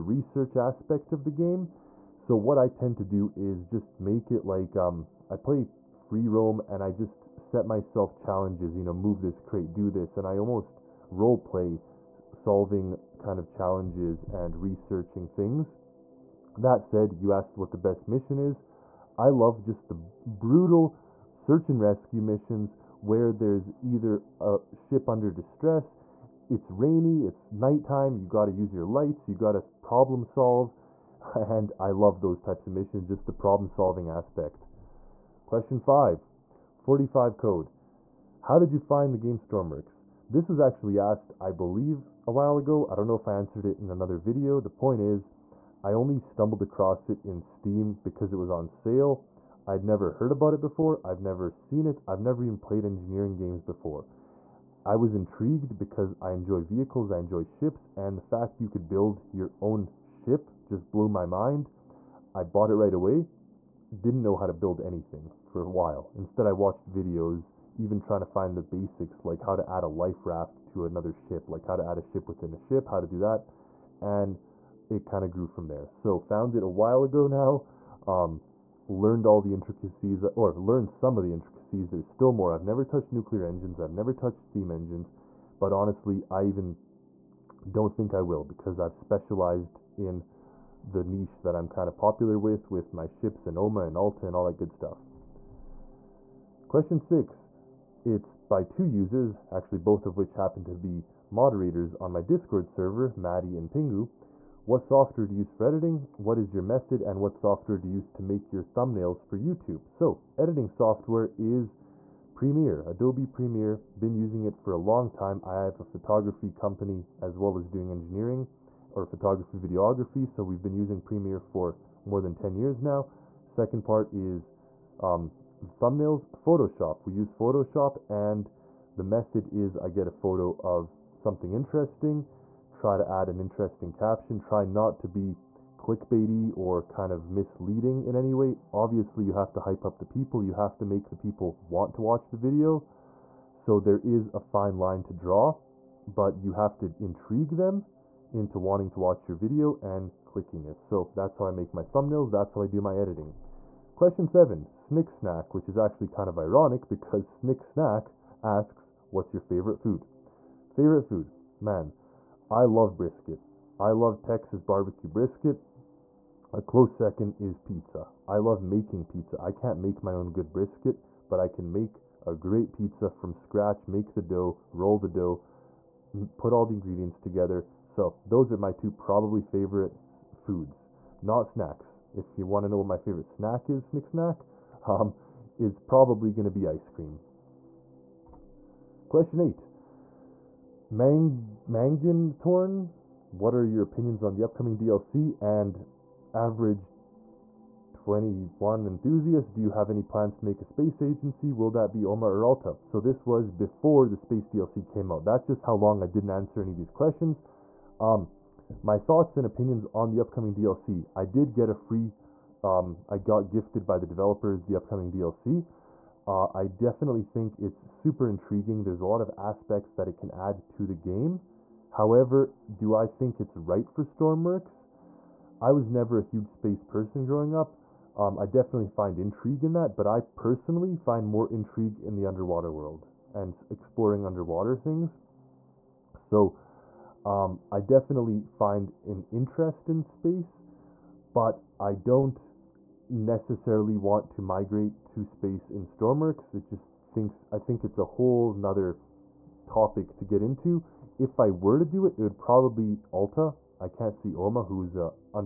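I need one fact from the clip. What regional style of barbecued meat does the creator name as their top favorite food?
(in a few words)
Texas barbecue brisket.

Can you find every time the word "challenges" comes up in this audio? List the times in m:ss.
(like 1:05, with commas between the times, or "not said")
0:08, 0:13.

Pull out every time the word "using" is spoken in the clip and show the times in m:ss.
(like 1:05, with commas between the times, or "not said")
1:54, 2:00.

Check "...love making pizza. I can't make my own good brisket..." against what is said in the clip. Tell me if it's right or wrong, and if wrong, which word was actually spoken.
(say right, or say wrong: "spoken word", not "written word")
right.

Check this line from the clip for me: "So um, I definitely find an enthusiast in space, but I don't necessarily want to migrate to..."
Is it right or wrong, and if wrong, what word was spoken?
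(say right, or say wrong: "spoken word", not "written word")
wrong: "interest", not "enthusiast".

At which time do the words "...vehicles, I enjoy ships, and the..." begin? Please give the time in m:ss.
0:56.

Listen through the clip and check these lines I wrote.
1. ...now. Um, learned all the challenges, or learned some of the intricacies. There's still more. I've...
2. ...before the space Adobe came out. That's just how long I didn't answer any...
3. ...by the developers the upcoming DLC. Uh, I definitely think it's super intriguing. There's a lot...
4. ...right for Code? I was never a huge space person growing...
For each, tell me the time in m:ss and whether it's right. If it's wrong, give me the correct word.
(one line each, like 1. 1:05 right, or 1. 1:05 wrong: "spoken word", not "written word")
1. 1:17 wrong: "intricacies", not "challenges"
2. 3:23 wrong: "DLC", not "Adobe"
3. 3:33 right
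4. 3:43 wrong: "Stormworks", not "Code".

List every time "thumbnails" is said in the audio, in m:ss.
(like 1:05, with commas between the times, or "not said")
1:48, 2:05, 2:31.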